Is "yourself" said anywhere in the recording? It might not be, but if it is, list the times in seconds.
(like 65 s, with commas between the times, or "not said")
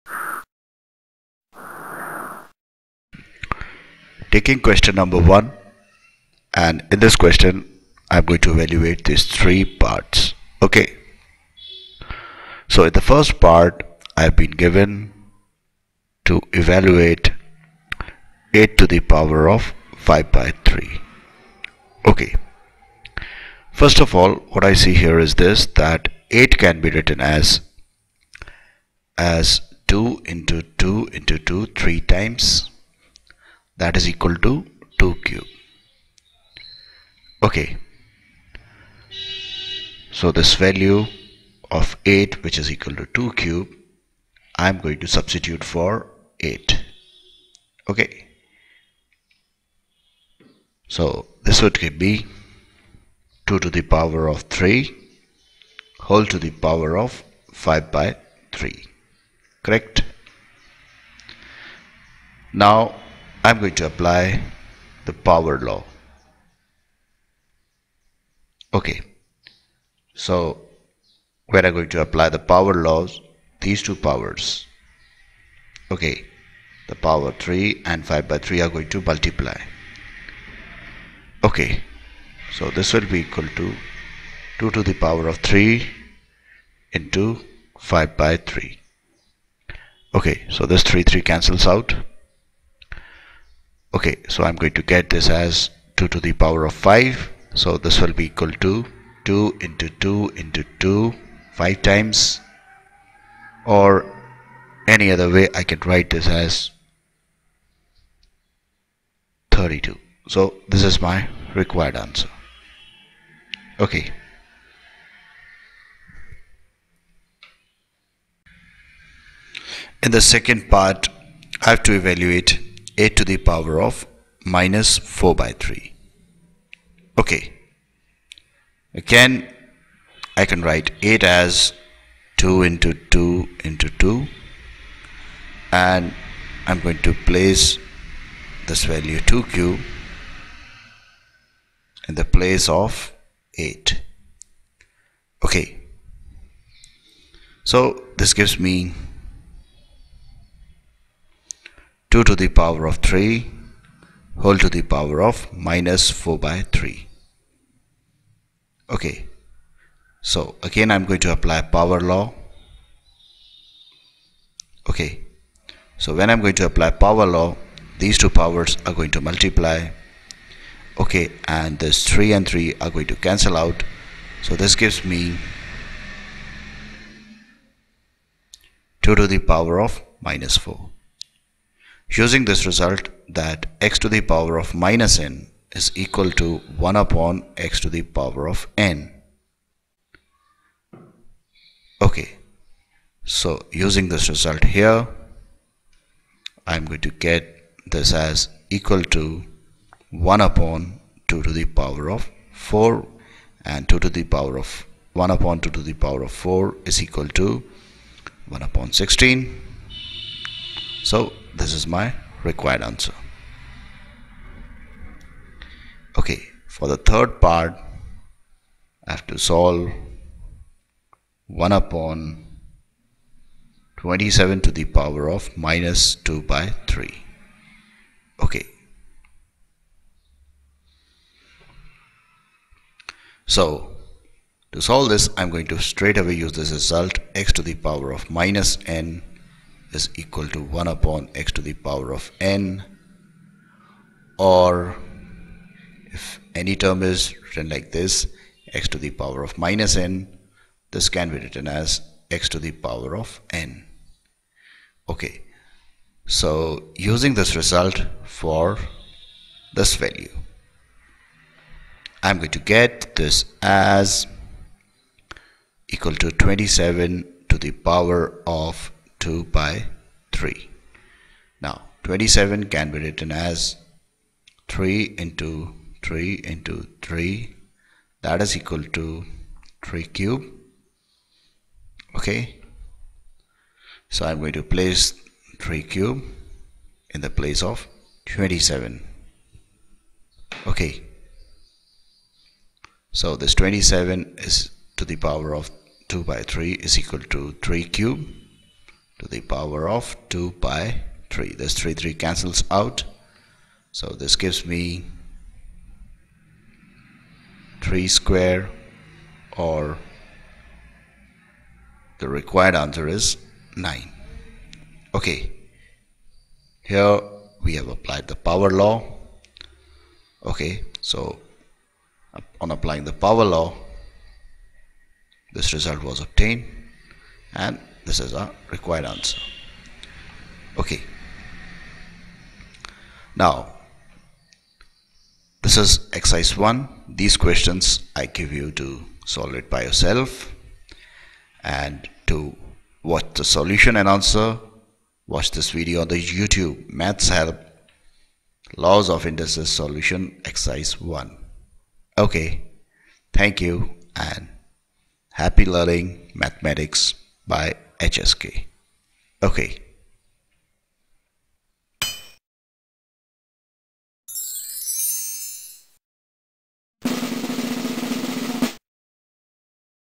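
339 s.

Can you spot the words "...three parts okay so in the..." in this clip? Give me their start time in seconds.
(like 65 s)
9 s.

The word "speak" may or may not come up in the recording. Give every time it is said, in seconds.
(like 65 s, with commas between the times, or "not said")
not said.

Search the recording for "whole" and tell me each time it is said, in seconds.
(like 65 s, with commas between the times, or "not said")
56 s, 154 s.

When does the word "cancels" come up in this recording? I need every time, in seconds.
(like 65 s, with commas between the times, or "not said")
91 s, 173 s, 302 s.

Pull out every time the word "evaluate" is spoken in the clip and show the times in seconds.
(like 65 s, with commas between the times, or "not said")
8 s, 16 s, 121 s.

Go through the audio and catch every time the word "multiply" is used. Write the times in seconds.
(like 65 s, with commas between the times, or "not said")
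79 s, 169 s.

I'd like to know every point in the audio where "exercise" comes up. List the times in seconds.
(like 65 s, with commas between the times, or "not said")
336 s, 350 s.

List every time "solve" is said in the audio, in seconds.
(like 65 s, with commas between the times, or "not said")
219 s, 234 s, 339 s.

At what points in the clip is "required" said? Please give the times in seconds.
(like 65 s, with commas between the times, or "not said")
111 s, 212 s, 312 s, 328 s.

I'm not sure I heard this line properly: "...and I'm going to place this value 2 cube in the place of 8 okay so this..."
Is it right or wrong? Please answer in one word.
right.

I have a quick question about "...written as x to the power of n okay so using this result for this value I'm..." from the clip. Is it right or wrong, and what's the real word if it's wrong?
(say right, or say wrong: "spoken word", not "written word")
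right.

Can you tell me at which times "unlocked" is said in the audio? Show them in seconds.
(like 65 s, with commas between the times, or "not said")
not said.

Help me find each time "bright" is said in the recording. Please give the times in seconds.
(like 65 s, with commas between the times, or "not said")
not said.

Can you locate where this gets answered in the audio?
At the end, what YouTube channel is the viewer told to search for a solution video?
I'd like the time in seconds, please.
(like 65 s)
346 s.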